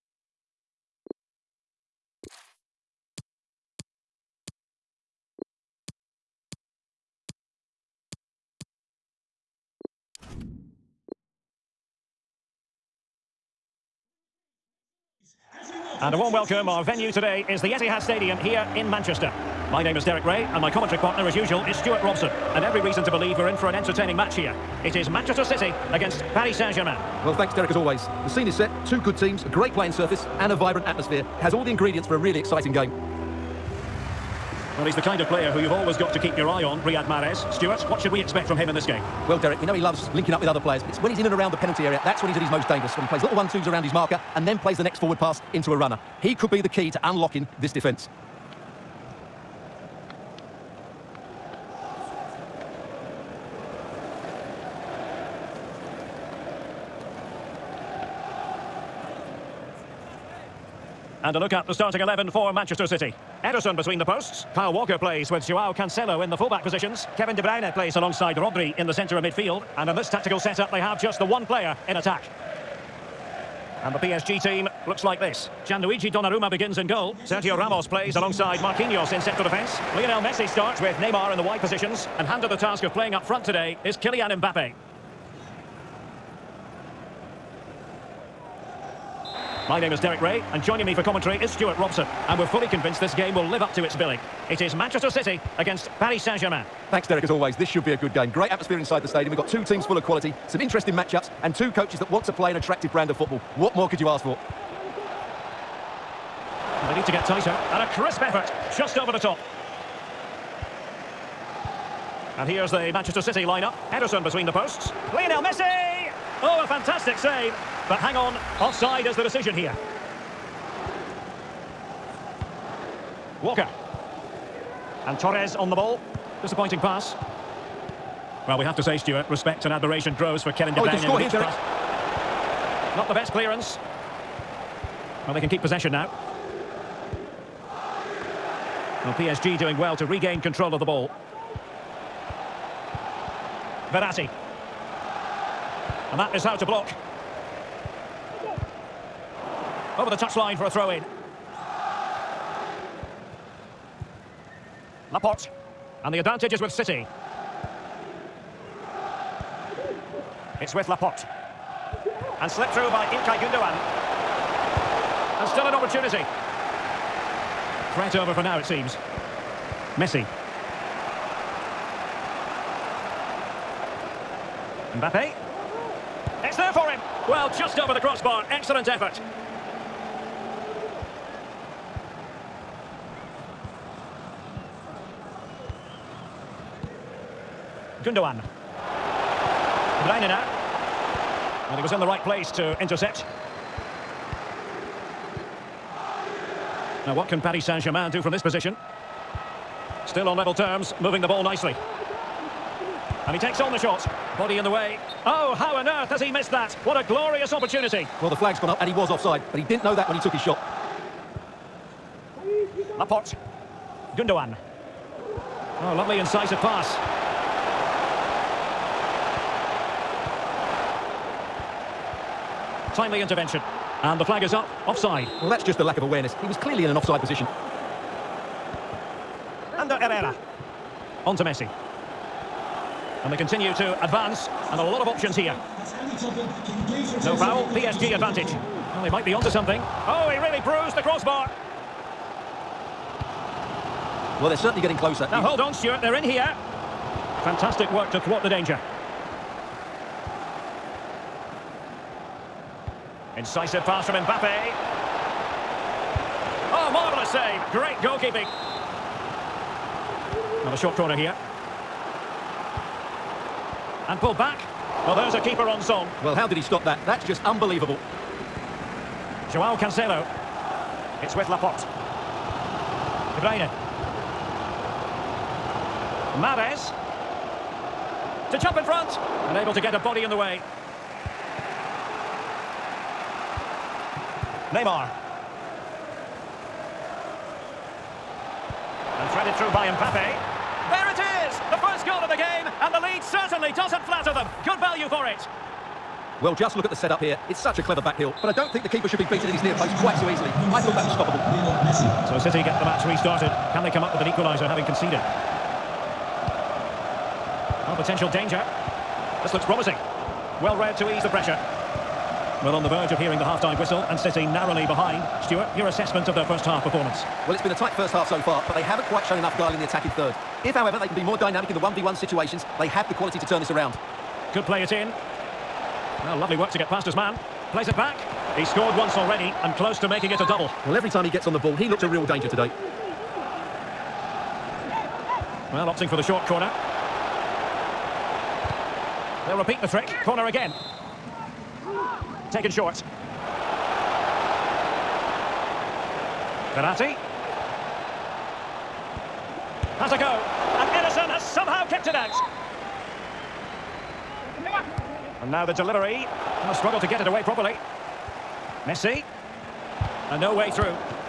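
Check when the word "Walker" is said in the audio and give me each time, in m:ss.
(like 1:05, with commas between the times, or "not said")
1:04, 2:03.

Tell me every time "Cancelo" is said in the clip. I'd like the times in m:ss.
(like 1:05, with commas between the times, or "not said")
1:05, 4:29.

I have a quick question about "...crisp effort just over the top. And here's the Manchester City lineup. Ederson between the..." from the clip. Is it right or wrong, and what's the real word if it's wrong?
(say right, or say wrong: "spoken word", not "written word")
right.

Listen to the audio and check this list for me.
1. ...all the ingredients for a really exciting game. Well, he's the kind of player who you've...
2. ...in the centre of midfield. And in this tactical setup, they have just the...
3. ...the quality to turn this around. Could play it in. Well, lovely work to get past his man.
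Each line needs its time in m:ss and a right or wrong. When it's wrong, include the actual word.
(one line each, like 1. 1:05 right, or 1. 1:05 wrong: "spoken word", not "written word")
1. 0:31 right
2. 1:08 right
3. 5:23 right.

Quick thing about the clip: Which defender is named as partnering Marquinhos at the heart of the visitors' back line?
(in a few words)
Sergio Ramos.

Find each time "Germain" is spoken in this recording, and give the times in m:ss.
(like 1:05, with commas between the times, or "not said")
0:26, 1:36, 3:17.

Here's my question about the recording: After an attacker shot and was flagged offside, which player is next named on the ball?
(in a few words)
Ander Herrera.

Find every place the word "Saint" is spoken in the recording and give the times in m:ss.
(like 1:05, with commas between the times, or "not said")
0:26, 1:36, 3:17.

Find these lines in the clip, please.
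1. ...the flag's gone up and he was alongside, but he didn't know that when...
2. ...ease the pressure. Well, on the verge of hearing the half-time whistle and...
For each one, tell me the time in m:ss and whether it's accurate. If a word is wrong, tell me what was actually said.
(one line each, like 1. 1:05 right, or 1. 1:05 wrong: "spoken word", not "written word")
1. 3:28 wrong: "offside", not "alongside"
2. 5:11 right.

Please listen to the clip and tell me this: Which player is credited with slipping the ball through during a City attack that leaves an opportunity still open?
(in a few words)
Ilkay Gundogan.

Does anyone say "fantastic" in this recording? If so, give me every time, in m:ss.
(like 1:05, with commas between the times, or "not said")
1:56, 4:07.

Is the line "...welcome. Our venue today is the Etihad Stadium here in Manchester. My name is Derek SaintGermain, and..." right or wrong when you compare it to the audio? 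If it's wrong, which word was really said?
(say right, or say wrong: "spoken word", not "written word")
wrong: "Rae", not "SaintGermain".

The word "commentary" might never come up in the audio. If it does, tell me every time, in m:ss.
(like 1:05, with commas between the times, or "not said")
0:20, 1:31.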